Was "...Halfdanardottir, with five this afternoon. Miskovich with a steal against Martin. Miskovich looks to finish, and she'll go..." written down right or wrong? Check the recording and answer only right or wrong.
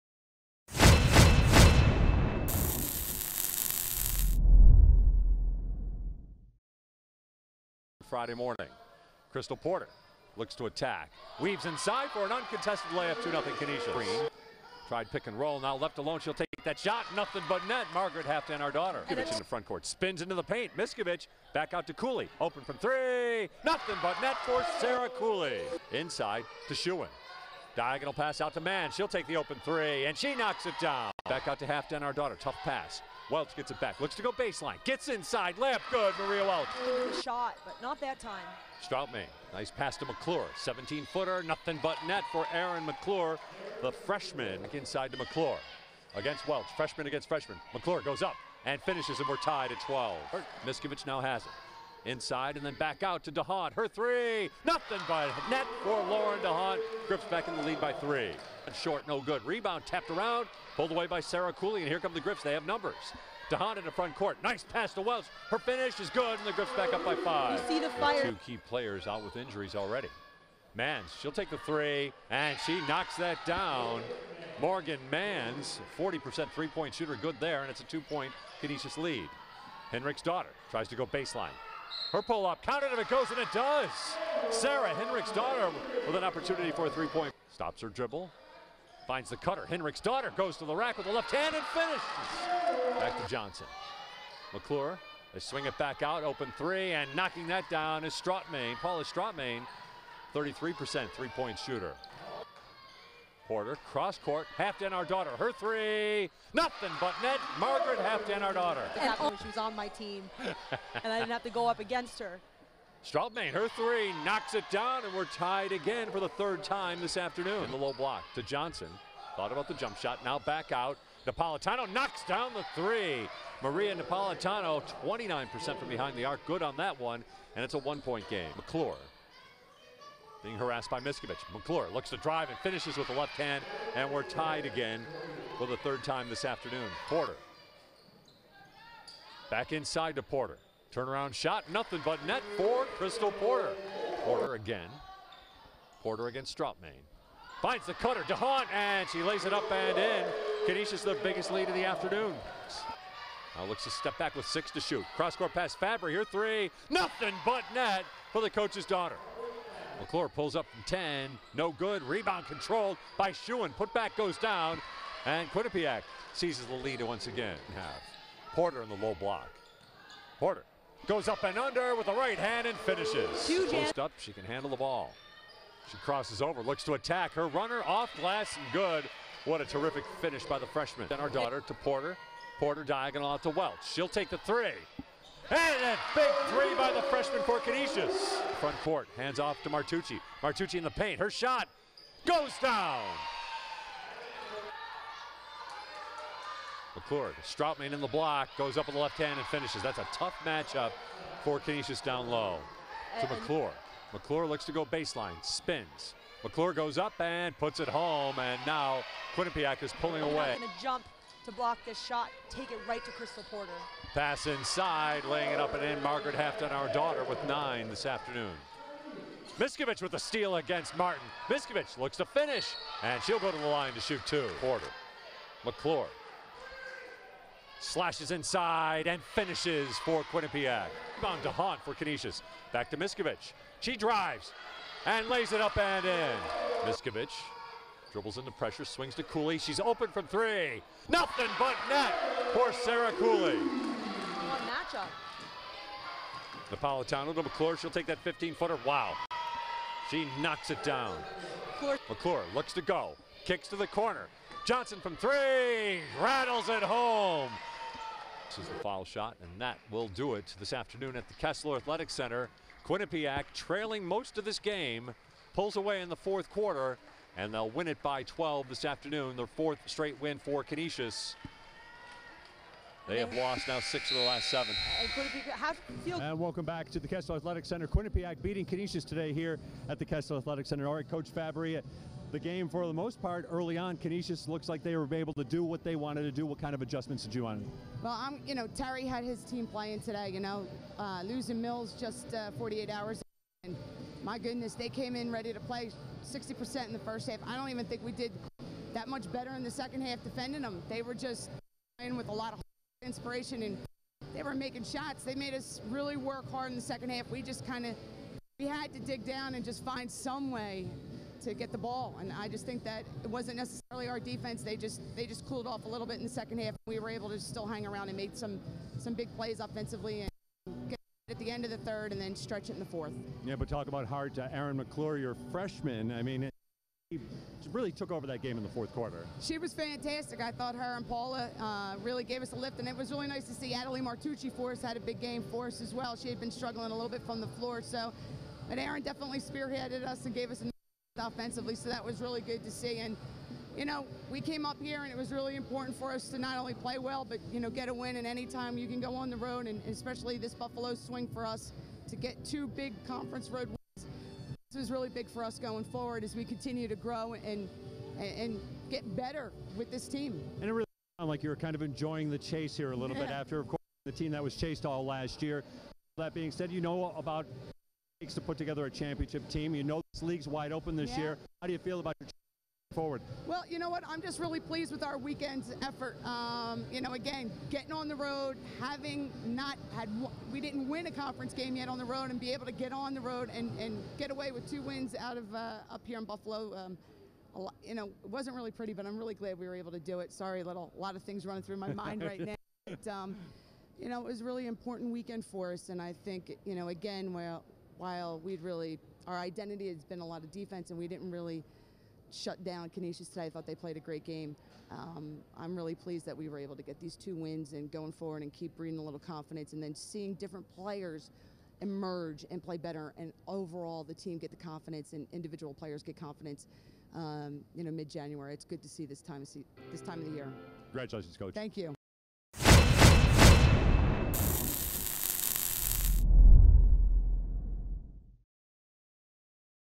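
wrong.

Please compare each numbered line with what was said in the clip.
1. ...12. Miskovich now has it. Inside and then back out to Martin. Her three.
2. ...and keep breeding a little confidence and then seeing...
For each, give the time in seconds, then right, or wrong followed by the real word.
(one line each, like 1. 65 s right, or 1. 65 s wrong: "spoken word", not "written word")
1. 49 s wrong: "DeHaan", not "Martin"
2. 408 s right.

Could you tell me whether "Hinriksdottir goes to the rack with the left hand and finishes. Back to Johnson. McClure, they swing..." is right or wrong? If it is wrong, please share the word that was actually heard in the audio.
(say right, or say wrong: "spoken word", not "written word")
right.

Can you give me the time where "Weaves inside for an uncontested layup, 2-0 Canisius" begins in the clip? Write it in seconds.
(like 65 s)
11 s.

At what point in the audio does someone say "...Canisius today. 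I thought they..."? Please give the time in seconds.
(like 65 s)
402 s.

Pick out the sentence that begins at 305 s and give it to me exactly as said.
They made us really work hard in the second half.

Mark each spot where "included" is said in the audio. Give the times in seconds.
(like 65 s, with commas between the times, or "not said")
not said.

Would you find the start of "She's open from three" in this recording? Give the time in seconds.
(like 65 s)
239 s.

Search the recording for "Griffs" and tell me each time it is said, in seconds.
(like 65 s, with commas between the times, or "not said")
57 s, 62 s, 66 s.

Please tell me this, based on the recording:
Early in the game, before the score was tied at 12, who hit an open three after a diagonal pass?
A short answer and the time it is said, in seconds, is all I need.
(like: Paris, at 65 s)
Mann, at 28 s.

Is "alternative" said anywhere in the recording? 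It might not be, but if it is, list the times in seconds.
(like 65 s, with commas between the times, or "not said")
not said.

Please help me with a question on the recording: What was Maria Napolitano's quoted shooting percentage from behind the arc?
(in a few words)
29%.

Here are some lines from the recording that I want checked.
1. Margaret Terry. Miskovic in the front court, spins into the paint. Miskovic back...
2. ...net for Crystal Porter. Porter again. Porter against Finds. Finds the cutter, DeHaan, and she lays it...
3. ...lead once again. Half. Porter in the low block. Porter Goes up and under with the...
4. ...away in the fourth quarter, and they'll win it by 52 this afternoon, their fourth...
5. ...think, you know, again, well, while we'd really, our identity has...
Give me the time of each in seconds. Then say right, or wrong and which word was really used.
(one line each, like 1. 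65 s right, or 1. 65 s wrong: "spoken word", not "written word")
1. 17 s wrong: "Halfdanardottir", not "Terry"
2. 142 s wrong: "Strautmann", not "Finds"
3. 166 s right
4. 265 s wrong: "12", not "52"
5. 396 s right.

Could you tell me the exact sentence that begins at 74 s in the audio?
Morgan Manz, 40% three-point shooter, good there, and it's a two-point Canisius lead.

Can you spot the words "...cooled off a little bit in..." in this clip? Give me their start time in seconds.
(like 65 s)
315 s.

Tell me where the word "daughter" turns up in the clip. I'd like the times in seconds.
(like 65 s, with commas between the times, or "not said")
158 s, 181 s.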